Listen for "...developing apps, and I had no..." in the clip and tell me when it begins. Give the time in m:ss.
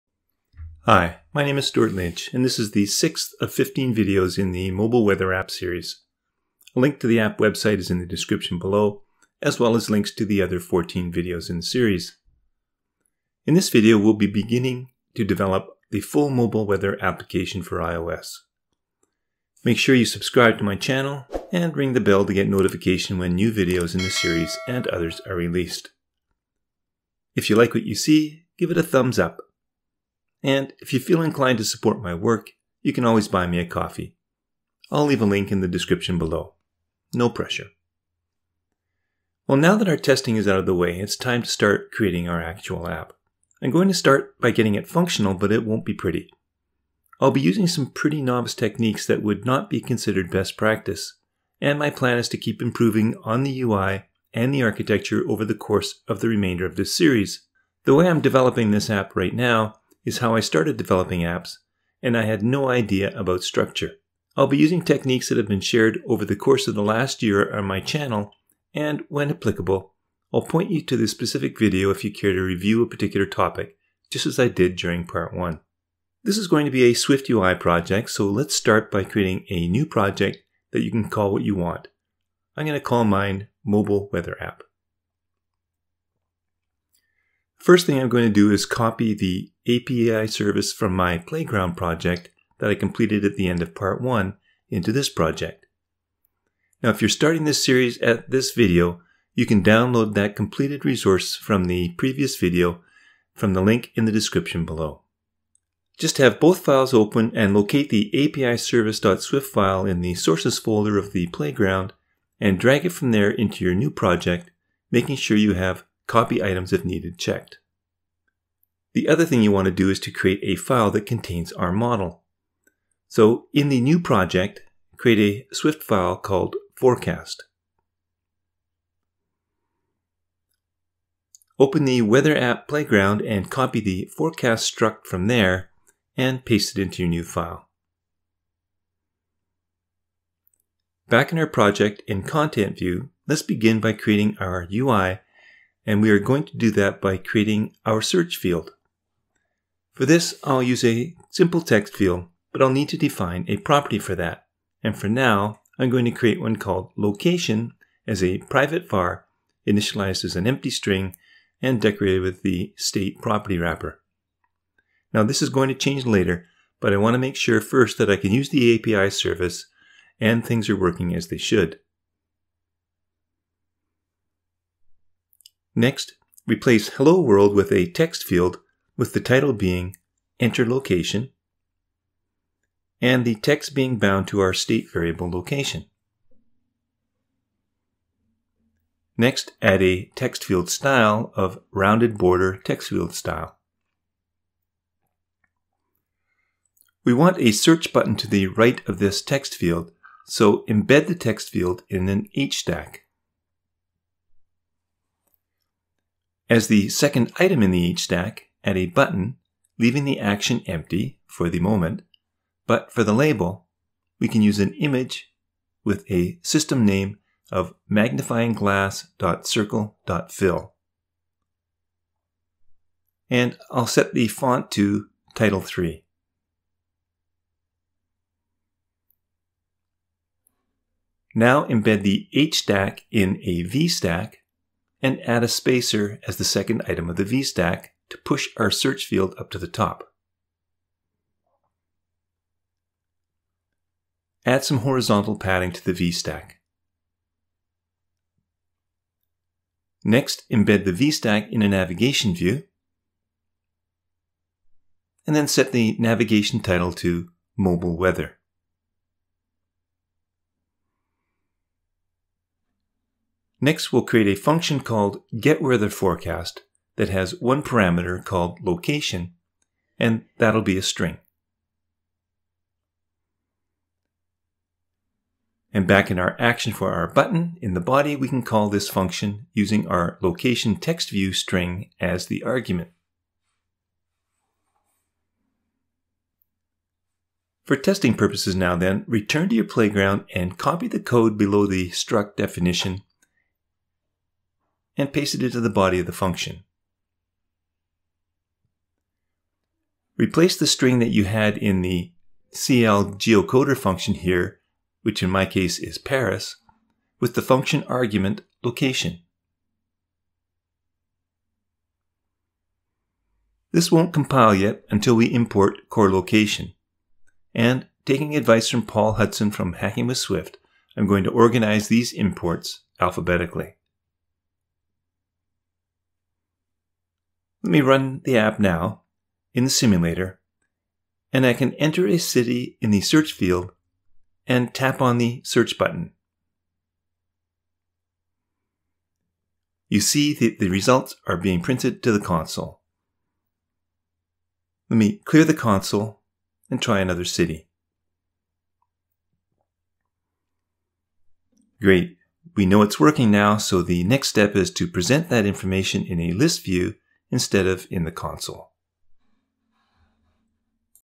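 1:00.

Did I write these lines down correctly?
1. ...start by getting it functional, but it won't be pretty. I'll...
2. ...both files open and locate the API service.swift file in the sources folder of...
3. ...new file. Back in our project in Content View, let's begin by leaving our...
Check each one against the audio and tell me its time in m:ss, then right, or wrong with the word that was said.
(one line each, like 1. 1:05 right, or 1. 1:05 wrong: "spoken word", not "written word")
1. 0:43 right
2. 1:46 right
3. 2:17 wrong: "creating", not "leaving".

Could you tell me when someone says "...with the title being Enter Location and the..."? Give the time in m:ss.
2:58.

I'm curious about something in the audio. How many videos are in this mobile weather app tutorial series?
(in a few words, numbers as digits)
15.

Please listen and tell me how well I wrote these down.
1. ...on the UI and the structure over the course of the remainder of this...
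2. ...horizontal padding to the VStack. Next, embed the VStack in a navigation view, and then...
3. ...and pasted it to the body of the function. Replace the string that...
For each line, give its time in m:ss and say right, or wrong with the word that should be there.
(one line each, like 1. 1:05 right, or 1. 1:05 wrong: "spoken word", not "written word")
1. 0:53 wrong: "architecture", not "structure"
2. 4:04 right
3. 4:54 right.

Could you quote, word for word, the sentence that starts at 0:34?
I'll leave a link in the description below.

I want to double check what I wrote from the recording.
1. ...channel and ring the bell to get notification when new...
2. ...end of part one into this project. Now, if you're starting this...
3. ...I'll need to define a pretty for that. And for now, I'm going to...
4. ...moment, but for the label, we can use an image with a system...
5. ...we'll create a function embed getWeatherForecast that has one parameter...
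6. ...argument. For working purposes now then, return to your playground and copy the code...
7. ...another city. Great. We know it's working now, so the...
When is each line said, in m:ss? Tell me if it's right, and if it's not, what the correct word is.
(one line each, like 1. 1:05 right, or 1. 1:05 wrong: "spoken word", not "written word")
1. 0:20 right
2. 1:33 right
3. 2:32 wrong: "property", not "pretty"
4. 3:31 right
5. 4:23 wrong: "called", not "embed"
6. 4:42 wrong: "testing", not "working"
7. 5:46 right.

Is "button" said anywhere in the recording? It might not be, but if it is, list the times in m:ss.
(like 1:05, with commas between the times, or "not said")
3:17, 3:28, 4:37, 5:35.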